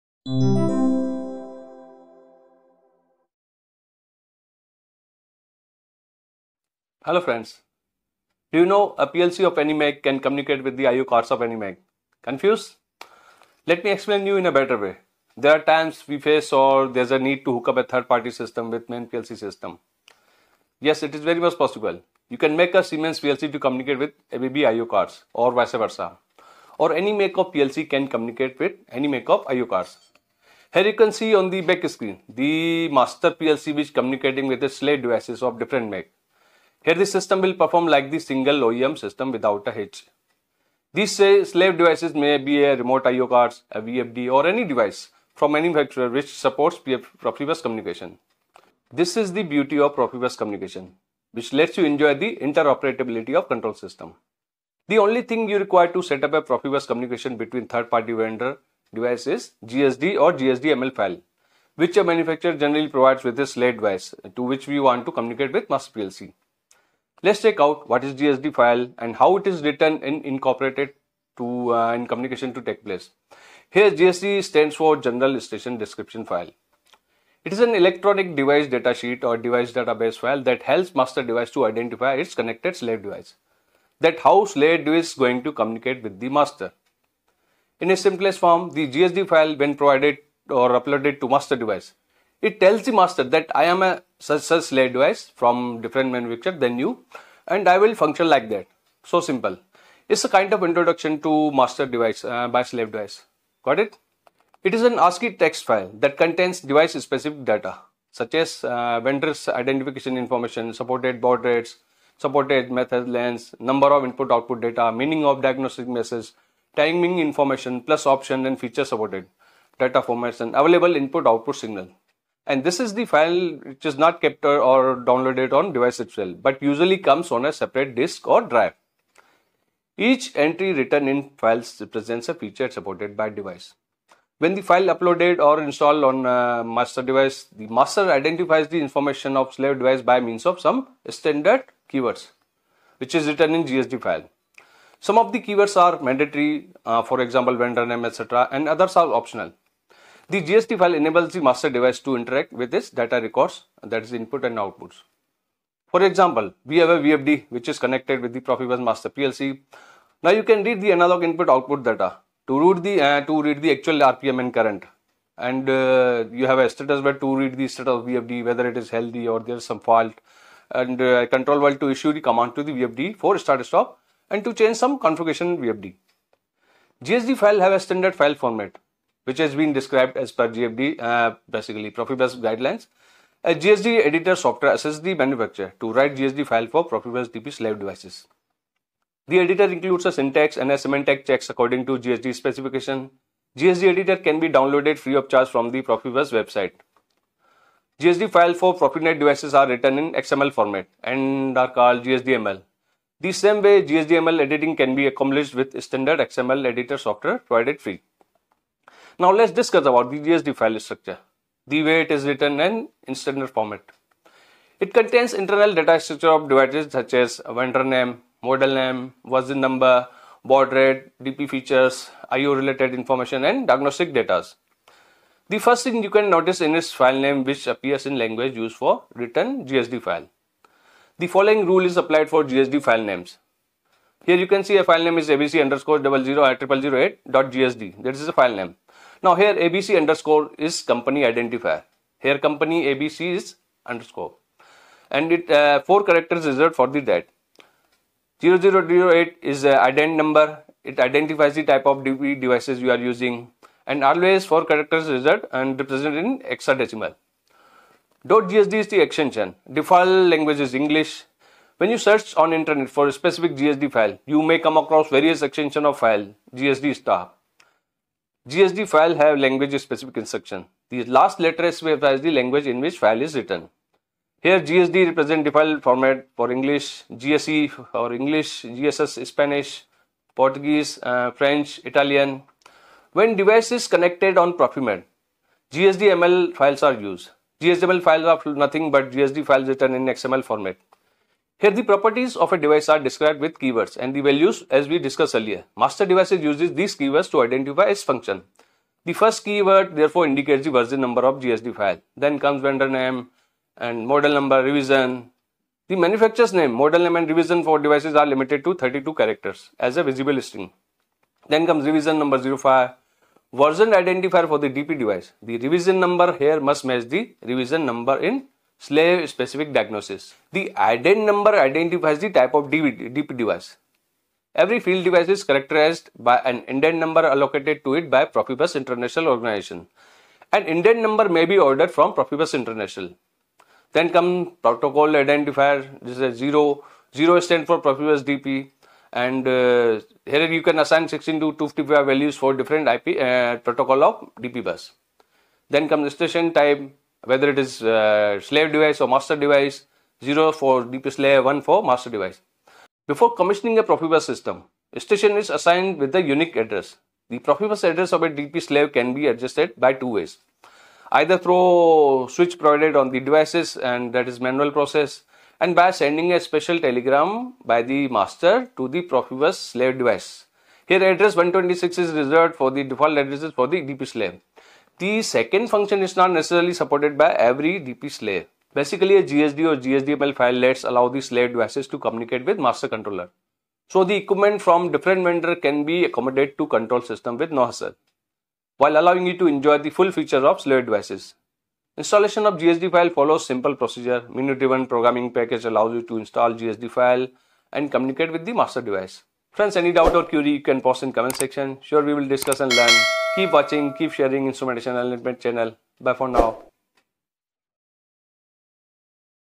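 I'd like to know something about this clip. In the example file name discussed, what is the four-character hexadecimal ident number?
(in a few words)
0008.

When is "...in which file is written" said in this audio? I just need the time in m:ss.
4:32.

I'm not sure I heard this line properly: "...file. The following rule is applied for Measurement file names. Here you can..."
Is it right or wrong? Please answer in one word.
wrong.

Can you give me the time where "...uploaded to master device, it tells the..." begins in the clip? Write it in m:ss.
1:30.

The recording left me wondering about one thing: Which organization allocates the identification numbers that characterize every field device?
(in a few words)
Profibus International Organization.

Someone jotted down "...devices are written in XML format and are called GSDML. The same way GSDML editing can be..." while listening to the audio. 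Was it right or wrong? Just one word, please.
right.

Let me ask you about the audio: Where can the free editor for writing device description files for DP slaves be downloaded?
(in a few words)
Profibus website.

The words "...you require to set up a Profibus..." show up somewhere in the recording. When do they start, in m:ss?
0:55.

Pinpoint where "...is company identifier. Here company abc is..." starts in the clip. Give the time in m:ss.
4:00.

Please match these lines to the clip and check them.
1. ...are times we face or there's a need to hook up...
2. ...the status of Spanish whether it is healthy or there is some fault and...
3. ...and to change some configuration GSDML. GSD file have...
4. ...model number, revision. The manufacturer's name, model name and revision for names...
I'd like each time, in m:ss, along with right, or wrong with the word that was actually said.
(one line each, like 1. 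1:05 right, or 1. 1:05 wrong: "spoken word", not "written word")
1. 0:15 right
2. 2:47 wrong: "VFD", not "Spanish"
3. 2:54 wrong: "VFD", not "GSDML"
4. 5:04 wrong: "devices", not "names".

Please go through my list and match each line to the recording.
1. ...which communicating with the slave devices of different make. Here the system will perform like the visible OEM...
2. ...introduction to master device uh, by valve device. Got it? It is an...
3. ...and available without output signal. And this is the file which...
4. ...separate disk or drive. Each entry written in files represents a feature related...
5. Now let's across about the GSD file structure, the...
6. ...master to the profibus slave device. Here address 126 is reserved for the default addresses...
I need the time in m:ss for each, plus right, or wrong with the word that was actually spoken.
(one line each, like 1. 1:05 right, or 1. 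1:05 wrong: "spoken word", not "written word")
1. 0:33 wrong: "single", not "visible"
2. 1:40 wrong: "slave", not "valve"
3. 2:00 wrong: "input", not "without"
4. 2:07 wrong: "supported", not "related"
5. 3:29 wrong: "discuss", not "across"
6. 6:08 right.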